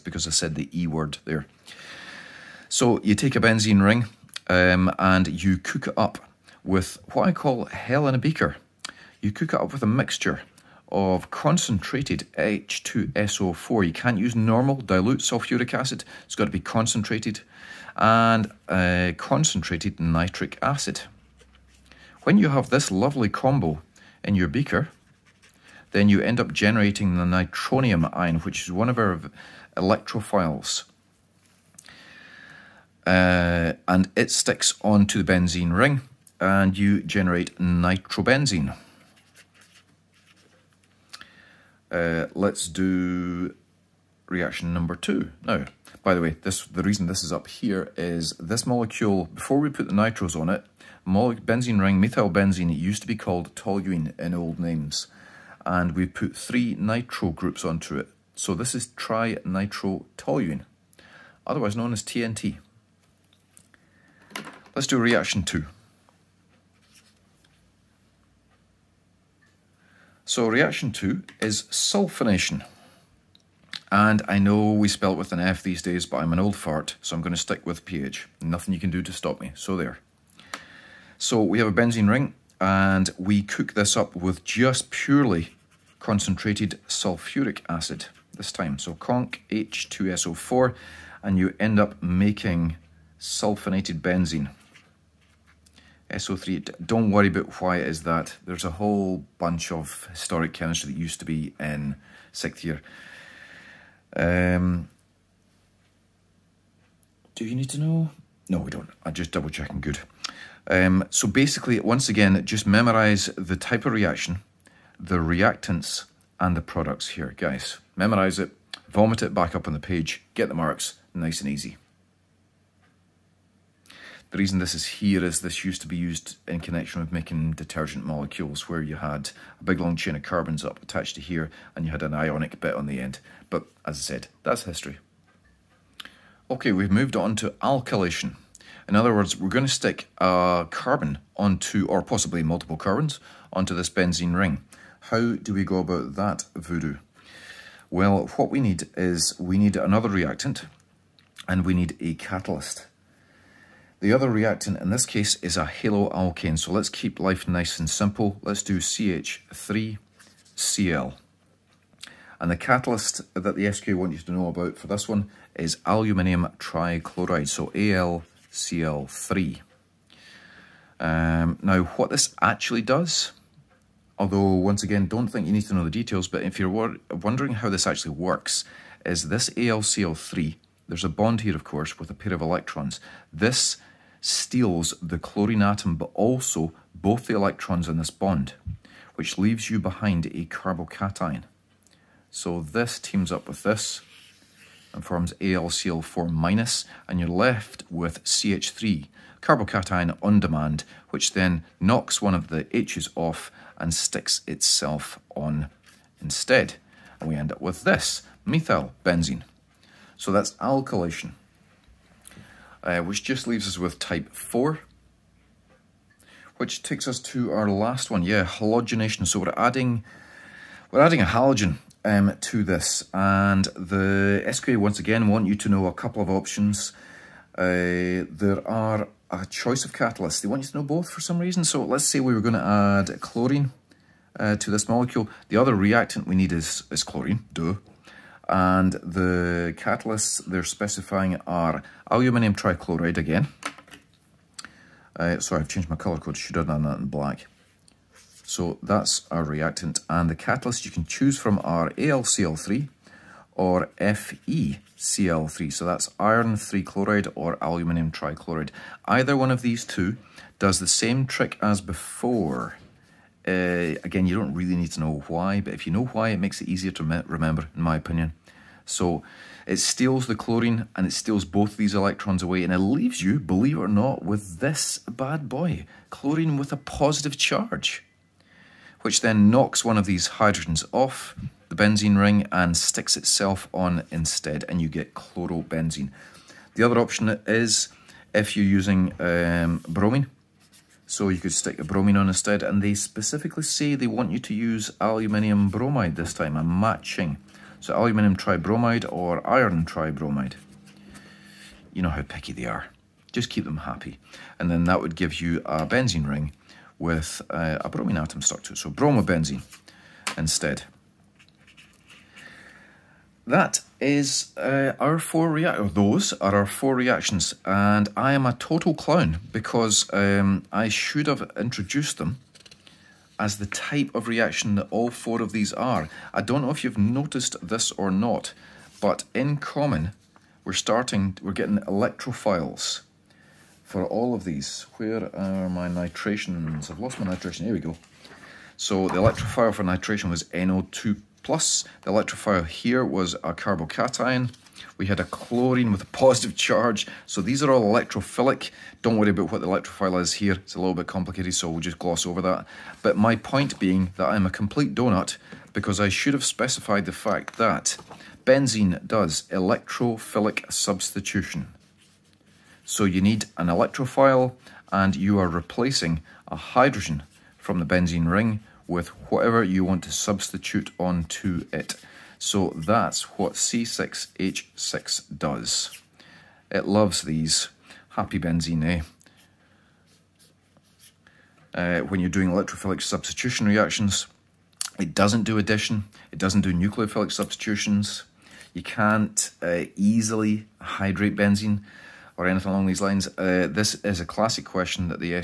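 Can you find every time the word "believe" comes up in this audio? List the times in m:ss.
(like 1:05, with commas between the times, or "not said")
4:33.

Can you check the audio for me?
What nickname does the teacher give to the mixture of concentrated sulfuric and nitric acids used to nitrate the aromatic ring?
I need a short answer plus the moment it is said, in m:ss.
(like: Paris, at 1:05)
hell in a beaker, at 0:07.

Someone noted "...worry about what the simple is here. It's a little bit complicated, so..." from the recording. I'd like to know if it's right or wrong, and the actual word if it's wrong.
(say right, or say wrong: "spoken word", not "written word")
wrong: "electrophile", not "simple".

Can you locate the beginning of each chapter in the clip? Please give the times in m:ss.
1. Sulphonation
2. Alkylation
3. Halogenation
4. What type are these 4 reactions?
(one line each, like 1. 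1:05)
1. 1:03
2. 2:15
3. 3:34
4. 5:14.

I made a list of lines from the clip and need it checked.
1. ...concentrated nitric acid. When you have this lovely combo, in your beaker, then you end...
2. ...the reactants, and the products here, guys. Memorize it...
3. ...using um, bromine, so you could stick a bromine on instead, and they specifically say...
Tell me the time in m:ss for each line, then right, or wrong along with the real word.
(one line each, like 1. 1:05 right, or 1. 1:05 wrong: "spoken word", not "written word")
1. 0:19 right
2. 1:54 right
3. 4:48 right.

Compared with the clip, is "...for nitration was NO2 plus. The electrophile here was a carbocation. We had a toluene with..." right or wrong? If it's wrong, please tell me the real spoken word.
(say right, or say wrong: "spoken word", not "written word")
wrong: "chlorine", not "toluene".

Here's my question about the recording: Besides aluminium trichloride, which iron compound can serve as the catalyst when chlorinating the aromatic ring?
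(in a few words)
FeCl3.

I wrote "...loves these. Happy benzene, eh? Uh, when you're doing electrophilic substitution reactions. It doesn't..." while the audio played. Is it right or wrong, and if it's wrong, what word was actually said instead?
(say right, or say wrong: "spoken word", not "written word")
right.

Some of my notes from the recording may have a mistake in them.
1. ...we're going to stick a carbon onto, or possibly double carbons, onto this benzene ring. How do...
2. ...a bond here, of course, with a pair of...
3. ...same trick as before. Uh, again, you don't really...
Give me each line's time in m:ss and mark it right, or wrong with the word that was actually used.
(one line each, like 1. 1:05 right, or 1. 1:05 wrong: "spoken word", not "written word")
1. 2:19 wrong: "multiple", not "double"
2. 3:01 right
3. 4:20 right.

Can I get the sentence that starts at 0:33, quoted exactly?
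Uh, and it sticks onto the benzene ring and you generate nitrobenzene.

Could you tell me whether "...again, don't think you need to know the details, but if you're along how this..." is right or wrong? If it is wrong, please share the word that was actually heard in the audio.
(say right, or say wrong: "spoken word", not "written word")
wrong: "wondering", not "along".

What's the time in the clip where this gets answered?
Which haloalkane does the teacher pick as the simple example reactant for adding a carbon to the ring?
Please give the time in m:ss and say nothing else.
2:38.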